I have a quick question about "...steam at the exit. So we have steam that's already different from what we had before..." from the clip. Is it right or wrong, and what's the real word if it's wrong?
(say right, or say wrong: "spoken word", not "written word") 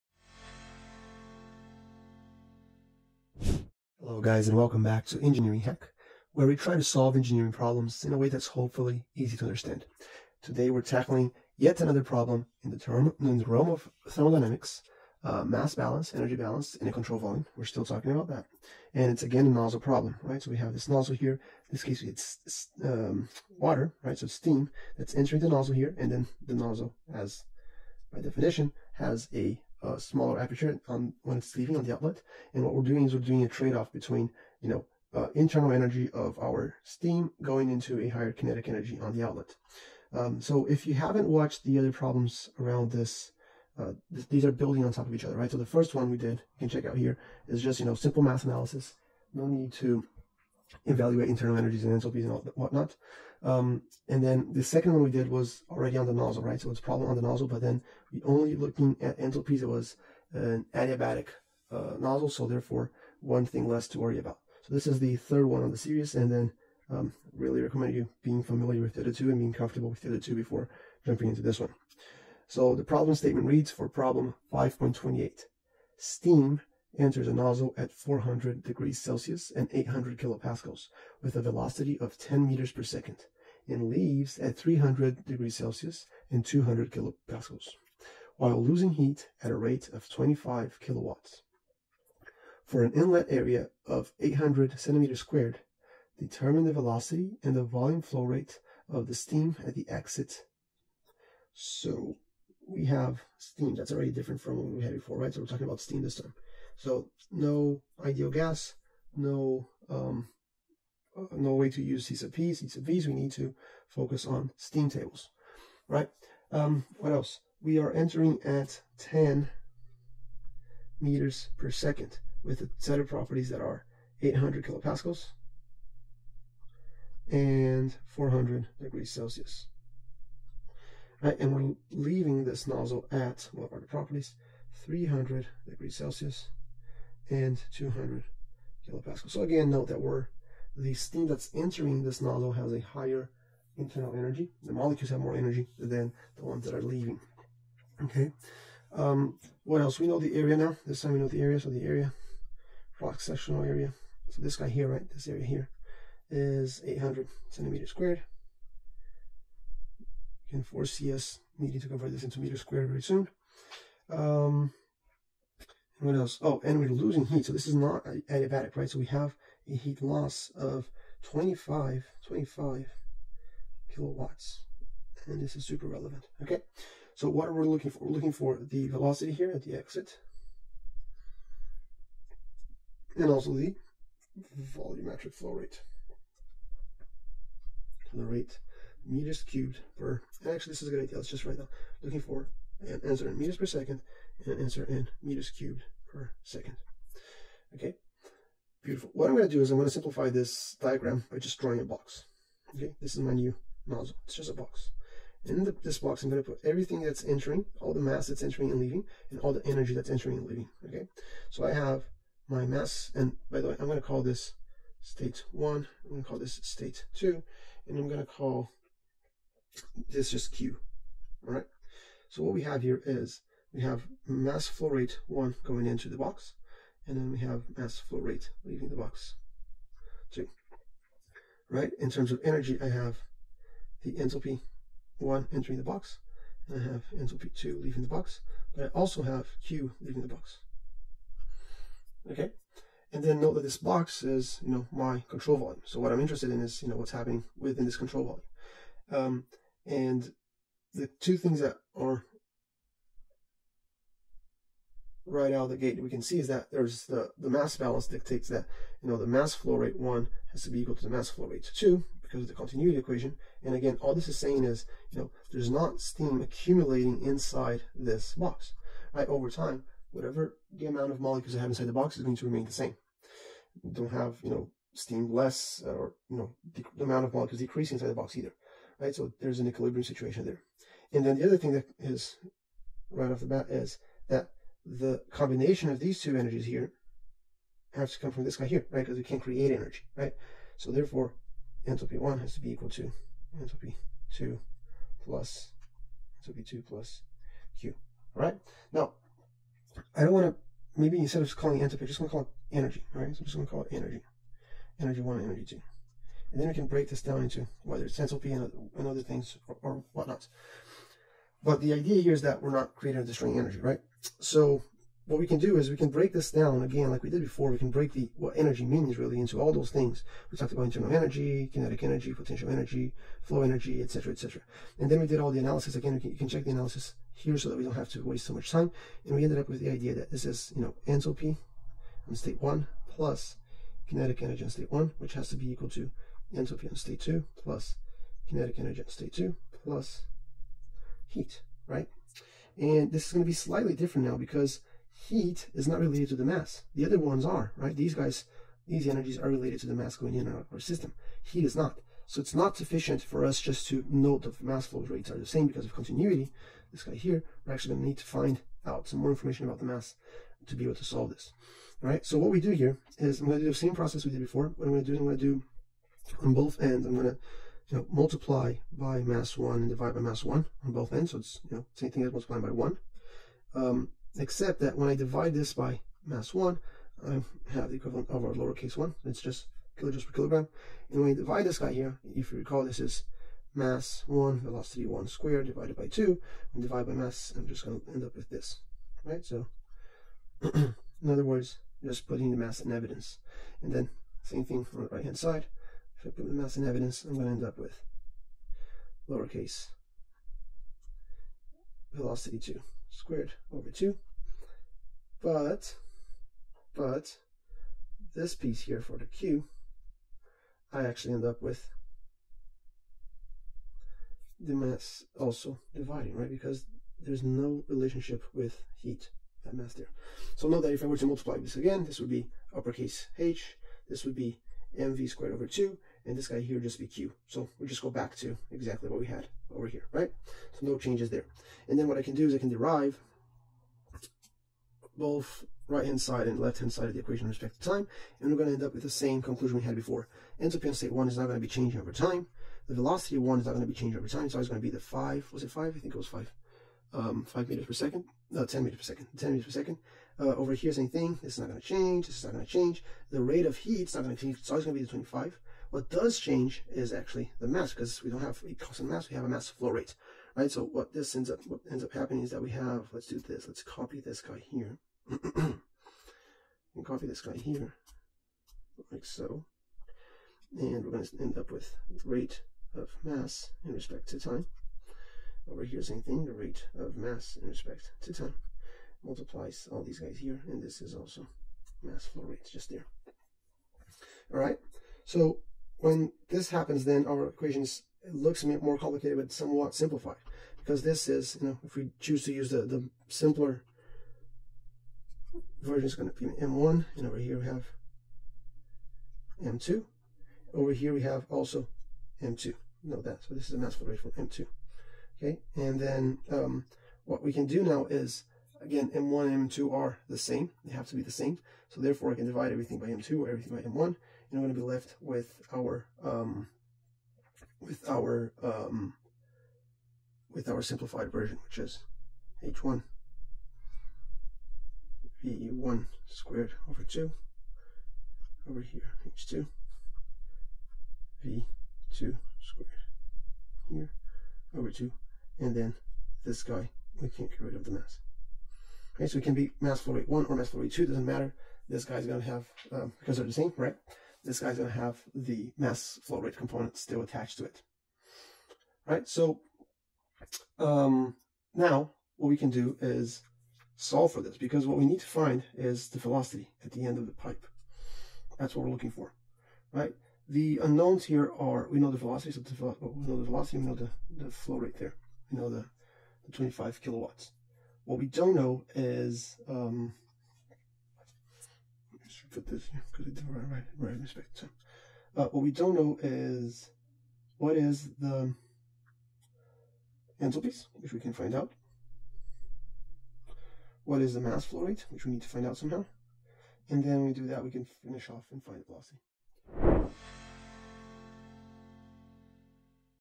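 right.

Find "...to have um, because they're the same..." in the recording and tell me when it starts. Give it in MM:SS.
09:02.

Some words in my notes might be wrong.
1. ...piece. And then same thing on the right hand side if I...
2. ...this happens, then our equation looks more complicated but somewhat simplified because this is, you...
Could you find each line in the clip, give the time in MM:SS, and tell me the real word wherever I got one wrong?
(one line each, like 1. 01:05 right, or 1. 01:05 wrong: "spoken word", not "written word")
1. 06:32 wrong: "evidence", not "piece"
2. 08:06 right.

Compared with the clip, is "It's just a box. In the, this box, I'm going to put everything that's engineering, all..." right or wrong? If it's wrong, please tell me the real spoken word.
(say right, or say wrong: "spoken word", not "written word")
wrong: "entering", not "engineering".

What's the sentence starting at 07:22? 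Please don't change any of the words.
The velocity of 1 is not going to be changing over time.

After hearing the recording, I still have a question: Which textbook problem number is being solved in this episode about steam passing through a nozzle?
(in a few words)
5.28.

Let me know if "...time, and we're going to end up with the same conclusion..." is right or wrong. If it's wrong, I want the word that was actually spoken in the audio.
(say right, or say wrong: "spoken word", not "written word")
right.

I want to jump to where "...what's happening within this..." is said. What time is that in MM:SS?
04:06.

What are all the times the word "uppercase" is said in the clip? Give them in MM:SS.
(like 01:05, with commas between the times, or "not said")
07:02.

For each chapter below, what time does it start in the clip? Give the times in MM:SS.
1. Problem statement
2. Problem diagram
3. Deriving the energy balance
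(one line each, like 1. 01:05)
1. 01:12
2. 03:19
3. 05:14.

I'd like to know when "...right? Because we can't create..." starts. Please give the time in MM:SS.
04:48.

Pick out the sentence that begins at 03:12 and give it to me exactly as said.
looking for an answer in meters per second and an answer in meters cubed per second.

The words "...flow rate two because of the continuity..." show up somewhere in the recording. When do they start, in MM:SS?
04:21.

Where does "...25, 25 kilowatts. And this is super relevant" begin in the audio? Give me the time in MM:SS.
02:51.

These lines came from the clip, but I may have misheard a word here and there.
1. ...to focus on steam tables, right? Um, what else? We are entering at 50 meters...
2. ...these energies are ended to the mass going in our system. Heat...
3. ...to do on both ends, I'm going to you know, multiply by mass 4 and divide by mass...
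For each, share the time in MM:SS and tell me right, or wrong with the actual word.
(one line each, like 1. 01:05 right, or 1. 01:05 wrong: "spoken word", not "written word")
1. 01:53 wrong: "10", not "50"
2. 05:48 wrong: "related", not "ended"
3. 06:05 wrong: "1", not "4".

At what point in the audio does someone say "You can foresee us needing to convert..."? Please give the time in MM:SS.
02:40.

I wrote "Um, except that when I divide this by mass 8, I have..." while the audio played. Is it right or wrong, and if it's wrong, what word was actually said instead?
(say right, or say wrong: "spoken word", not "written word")
wrong: "1", not "8".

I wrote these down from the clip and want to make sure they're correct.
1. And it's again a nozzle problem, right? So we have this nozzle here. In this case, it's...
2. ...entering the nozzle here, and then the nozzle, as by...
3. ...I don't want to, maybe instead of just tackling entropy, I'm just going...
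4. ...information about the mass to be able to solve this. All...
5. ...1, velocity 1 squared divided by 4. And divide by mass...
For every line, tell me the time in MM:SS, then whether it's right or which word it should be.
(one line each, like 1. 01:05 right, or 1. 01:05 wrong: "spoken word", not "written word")
1. 00:18 right
2. 00:25 right
3. 05:00 wrong: "calling", not "tackling"
4. 05:59 right
5. 06:24 wrong: "2", not "4".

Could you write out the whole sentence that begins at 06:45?
But, but, this piece here for the q, I actually end up with the mass also dividing, right?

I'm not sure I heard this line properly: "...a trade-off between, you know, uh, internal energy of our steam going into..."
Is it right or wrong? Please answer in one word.
right.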